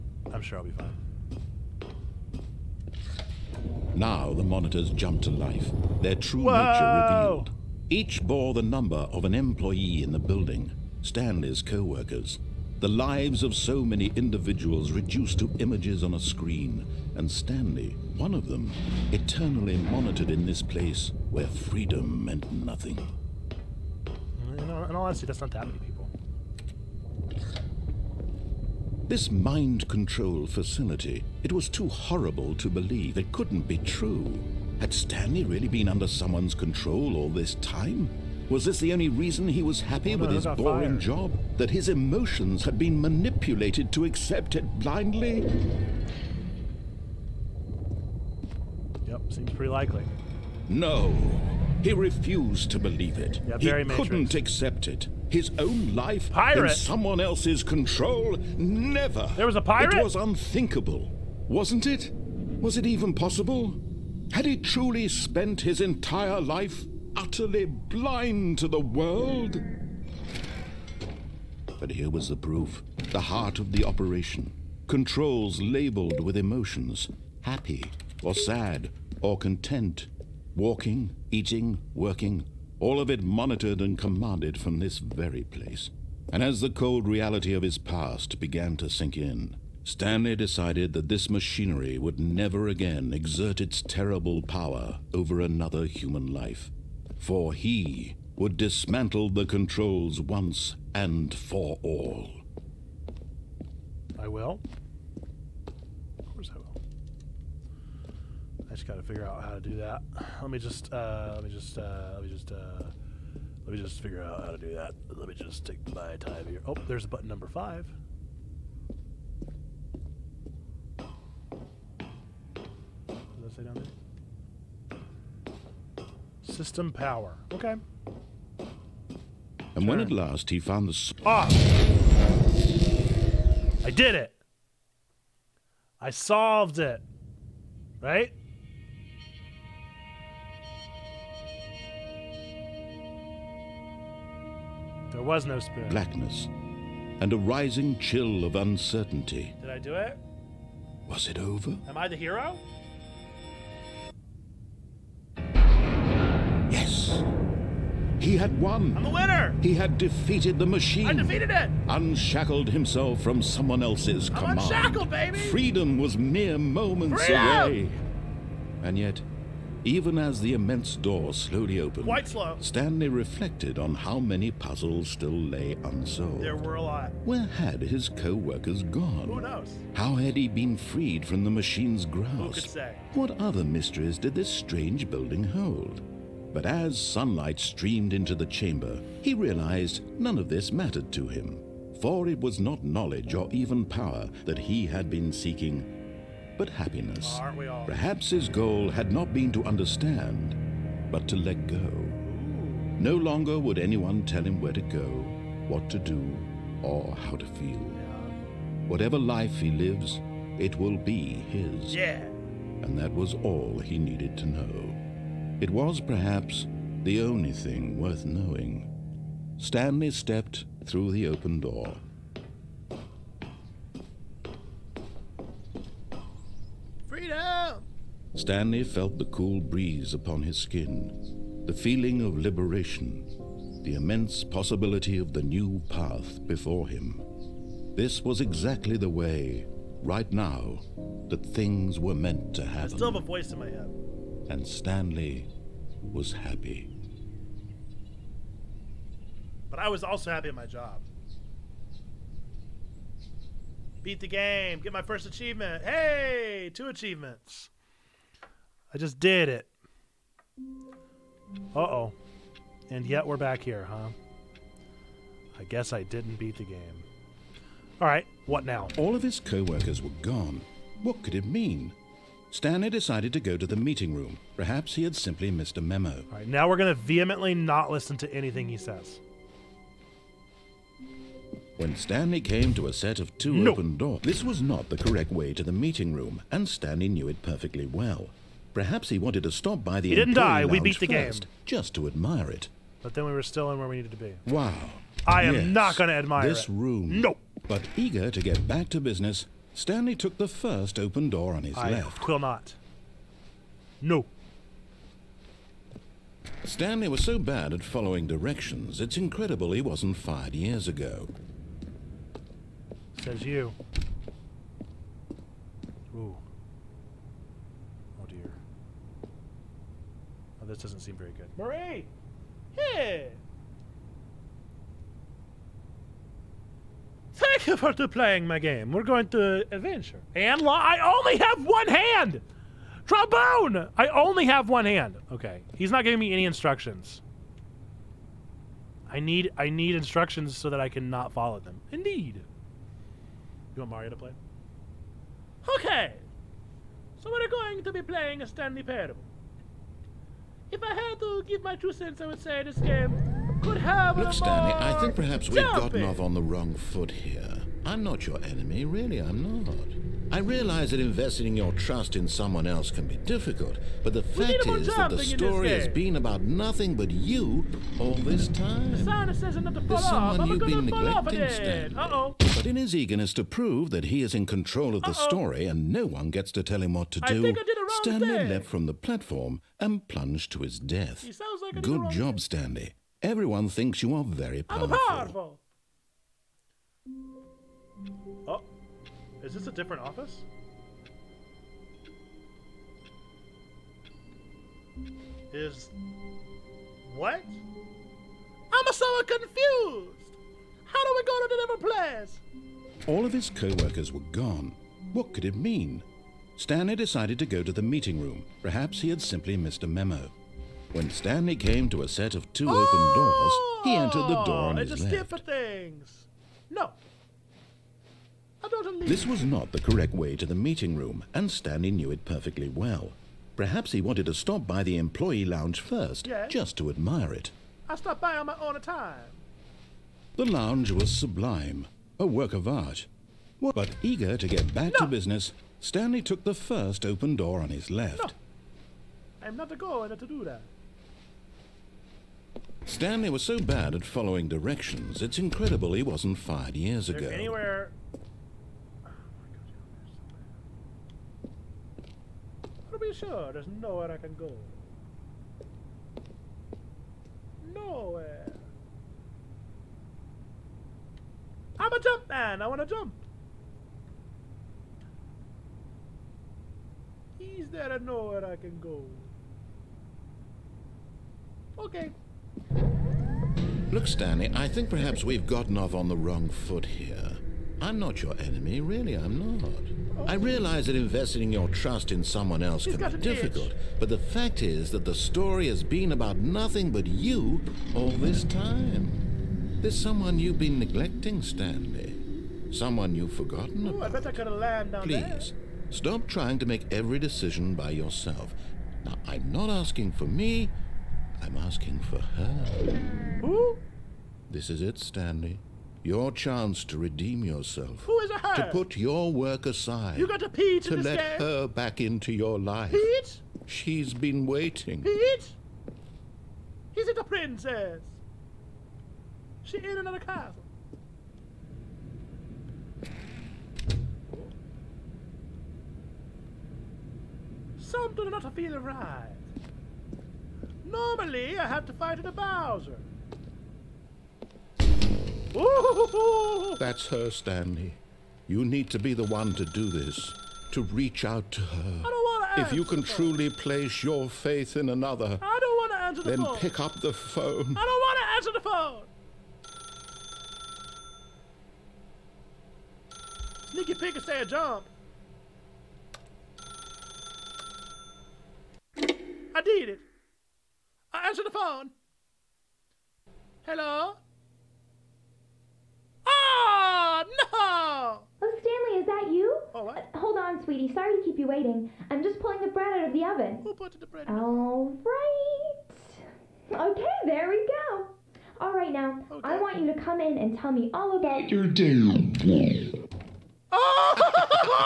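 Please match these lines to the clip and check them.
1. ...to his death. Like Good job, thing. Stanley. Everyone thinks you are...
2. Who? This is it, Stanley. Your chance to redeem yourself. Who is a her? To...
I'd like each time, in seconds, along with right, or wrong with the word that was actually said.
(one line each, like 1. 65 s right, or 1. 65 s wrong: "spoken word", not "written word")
1. 380 s right
2. 503 s right.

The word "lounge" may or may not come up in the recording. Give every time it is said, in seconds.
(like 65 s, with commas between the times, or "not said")
425 s, 430 s.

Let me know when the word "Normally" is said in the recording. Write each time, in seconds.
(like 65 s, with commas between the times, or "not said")
530 s.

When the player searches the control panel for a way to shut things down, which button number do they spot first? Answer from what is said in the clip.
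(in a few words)
5.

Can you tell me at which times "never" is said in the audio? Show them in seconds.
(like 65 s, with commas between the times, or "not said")
58 s, 92 s.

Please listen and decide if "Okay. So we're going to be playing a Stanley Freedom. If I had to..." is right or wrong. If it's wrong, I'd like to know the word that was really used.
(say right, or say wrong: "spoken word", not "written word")
wrong: "Parable", not "Freedom".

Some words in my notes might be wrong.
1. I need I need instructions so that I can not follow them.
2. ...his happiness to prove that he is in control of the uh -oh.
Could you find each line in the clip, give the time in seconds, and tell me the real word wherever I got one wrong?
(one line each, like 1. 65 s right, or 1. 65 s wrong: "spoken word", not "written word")
1. 339 s right
2. 372 s wrong: "eagerness", not "happiness".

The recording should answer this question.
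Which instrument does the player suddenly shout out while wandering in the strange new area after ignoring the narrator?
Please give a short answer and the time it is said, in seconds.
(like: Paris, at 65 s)
Trombone, at 333 s.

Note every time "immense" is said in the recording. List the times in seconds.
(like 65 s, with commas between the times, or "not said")
170 s, 233 s.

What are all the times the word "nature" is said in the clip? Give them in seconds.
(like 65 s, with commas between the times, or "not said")
6 s.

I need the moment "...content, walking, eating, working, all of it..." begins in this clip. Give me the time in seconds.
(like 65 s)
79 s.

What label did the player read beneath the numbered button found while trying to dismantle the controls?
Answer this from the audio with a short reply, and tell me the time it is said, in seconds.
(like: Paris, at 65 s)
System power, at 126 s.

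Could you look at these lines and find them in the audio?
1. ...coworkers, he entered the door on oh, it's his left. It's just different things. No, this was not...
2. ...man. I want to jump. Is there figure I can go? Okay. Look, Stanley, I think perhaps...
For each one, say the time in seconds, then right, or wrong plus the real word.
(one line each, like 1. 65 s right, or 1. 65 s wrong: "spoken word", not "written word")
1. 413 s wrong: "doors", not "coworkers"
2. 462 s wrong: "nowhere", not "figure".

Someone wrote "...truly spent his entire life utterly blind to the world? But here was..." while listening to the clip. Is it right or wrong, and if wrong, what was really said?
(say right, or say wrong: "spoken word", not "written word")
right.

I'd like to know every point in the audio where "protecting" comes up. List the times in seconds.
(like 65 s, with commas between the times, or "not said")
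not said.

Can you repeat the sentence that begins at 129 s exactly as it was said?
when at last he found the spot.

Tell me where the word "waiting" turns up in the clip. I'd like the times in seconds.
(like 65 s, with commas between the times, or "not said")
514 s, 571 s.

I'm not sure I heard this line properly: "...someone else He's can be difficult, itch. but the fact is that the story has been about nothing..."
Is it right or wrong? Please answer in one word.
right.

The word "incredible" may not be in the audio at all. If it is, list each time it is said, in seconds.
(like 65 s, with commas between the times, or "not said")
309 s, 445 s.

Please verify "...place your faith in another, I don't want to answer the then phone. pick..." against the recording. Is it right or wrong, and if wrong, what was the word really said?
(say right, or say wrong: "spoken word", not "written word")
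right.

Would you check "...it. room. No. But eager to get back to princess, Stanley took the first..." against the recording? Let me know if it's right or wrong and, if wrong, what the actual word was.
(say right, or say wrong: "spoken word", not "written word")
wrong: "business", not "princess".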